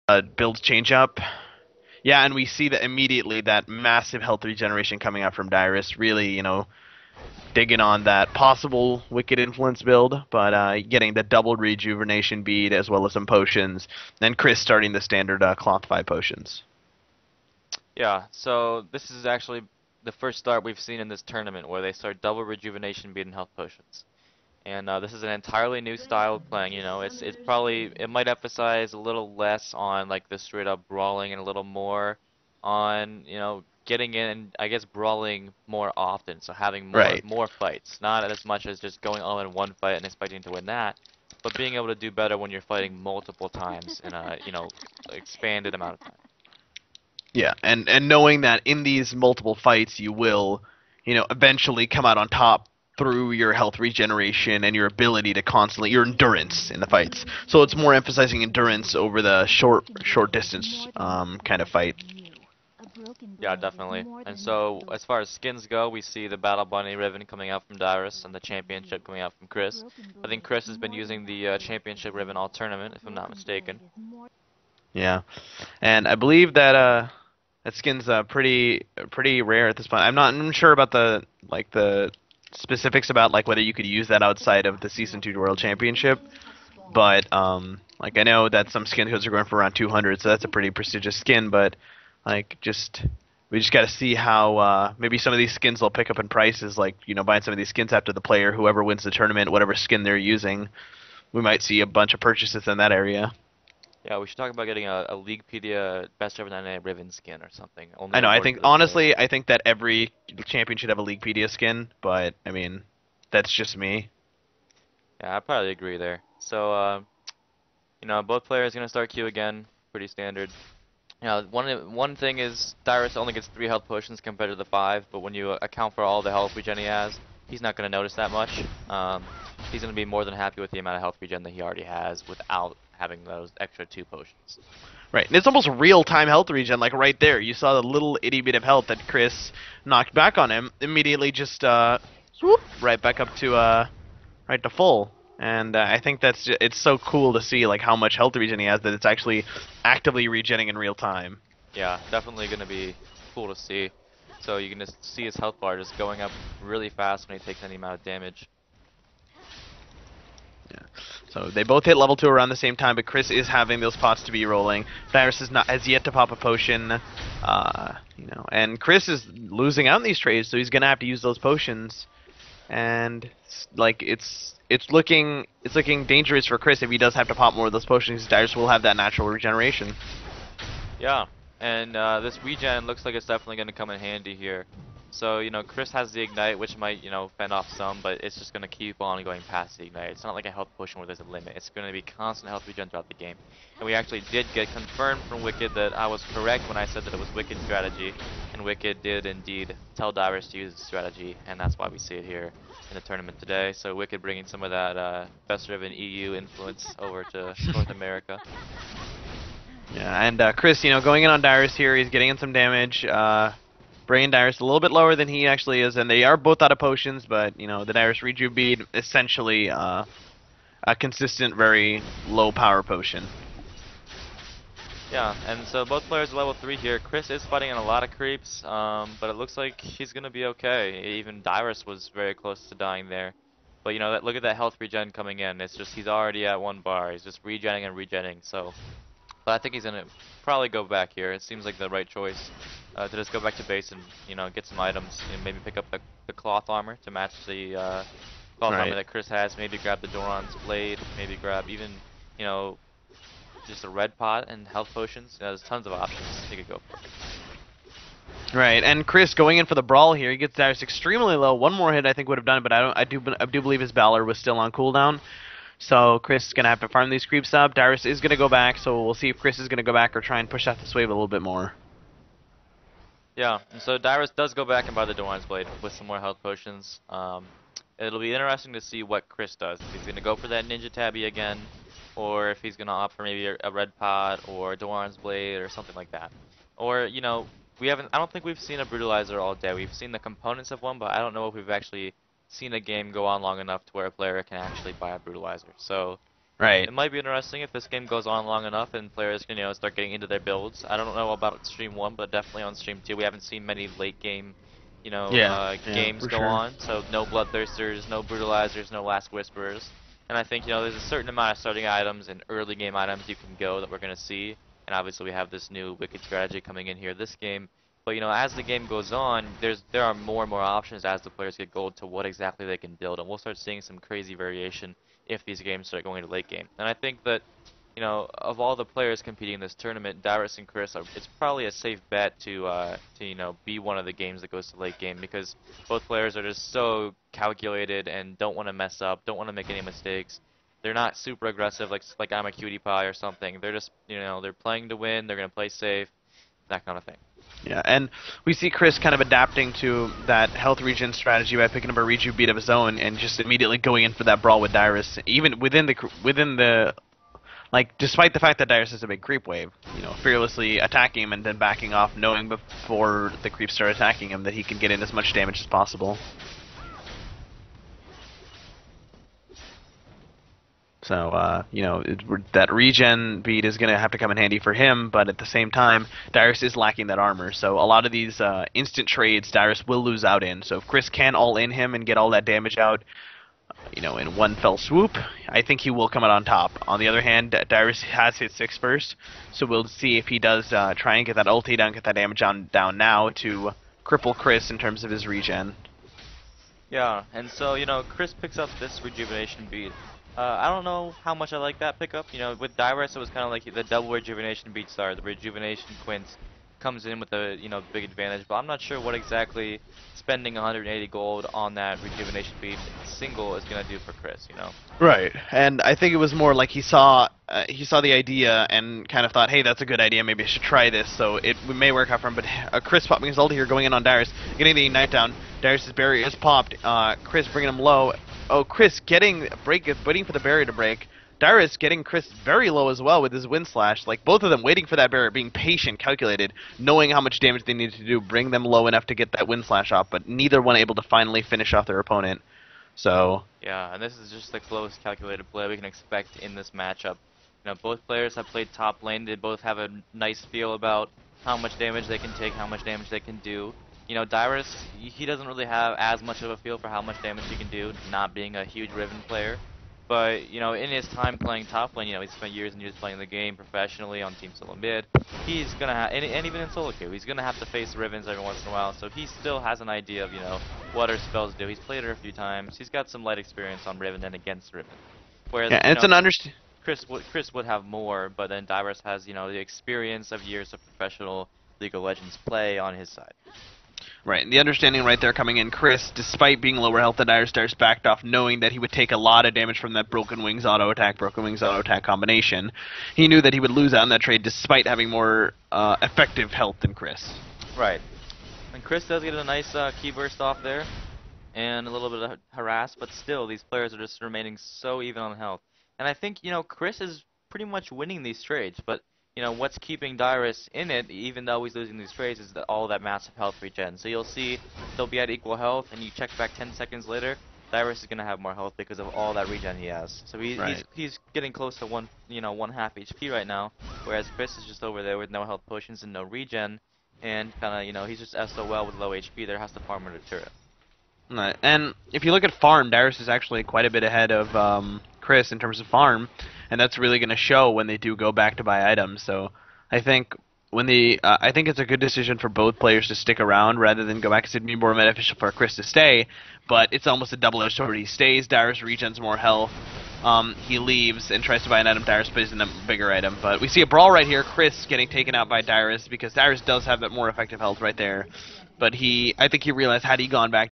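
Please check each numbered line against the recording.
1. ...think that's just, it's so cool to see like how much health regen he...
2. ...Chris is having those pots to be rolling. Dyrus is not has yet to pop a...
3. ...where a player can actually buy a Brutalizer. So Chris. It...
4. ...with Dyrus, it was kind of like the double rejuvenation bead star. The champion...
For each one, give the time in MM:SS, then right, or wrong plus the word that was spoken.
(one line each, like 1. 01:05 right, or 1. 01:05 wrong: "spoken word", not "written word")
1. 02:25 right
2. 02:43 right
3. 04:53 wrong: "Right", not "Chris"
4. 06:42 wrong: "rejuvenation", not "champion".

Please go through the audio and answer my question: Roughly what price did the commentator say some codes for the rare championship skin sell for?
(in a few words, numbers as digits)
200.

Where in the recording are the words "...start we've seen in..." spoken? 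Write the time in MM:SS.
00:20.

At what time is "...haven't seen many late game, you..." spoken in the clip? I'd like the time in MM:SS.
05:03.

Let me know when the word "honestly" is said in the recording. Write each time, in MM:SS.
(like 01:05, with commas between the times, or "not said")
01:48.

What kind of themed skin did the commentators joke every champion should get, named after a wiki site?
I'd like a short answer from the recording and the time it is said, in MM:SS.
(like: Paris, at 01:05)
Leaguepedia skin, at 01:51.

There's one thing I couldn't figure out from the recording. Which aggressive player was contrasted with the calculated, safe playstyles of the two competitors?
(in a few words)
Imaqtpie.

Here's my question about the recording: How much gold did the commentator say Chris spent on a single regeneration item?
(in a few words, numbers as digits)
180.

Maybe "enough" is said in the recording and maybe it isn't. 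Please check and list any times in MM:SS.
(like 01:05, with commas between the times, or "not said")
04:53, 04:58, 07:18.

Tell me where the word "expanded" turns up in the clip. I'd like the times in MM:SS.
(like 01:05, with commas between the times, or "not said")
00:45.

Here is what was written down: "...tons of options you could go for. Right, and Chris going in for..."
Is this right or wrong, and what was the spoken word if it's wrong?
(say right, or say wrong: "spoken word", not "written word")
right.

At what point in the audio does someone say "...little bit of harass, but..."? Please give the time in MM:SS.
08:21.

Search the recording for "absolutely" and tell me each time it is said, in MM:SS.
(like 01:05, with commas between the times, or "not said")
not said.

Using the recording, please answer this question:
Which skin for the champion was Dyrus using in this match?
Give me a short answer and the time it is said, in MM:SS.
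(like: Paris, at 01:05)
Battle Bunny, at 01:06.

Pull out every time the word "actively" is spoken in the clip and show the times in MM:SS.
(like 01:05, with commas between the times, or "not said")
02:29.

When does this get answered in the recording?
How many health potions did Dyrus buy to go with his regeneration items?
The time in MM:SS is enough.
02:03.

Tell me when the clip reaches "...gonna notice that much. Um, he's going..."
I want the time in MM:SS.
02:07.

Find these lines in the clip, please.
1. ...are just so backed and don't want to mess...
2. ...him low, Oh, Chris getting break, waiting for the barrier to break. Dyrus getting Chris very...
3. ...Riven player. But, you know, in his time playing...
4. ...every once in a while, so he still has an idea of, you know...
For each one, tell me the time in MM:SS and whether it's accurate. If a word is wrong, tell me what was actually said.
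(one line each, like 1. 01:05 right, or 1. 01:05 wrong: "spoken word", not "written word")
1. 05:36 wrong: "calculated", not "backed"
2. 07:07 right
3. 07:38 right
4. 07:48 right.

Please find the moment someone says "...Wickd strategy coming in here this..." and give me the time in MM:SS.
05:15.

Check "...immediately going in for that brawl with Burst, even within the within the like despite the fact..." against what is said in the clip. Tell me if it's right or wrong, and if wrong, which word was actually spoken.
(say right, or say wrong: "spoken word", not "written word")
wrong: "Dyrus", not "Burst".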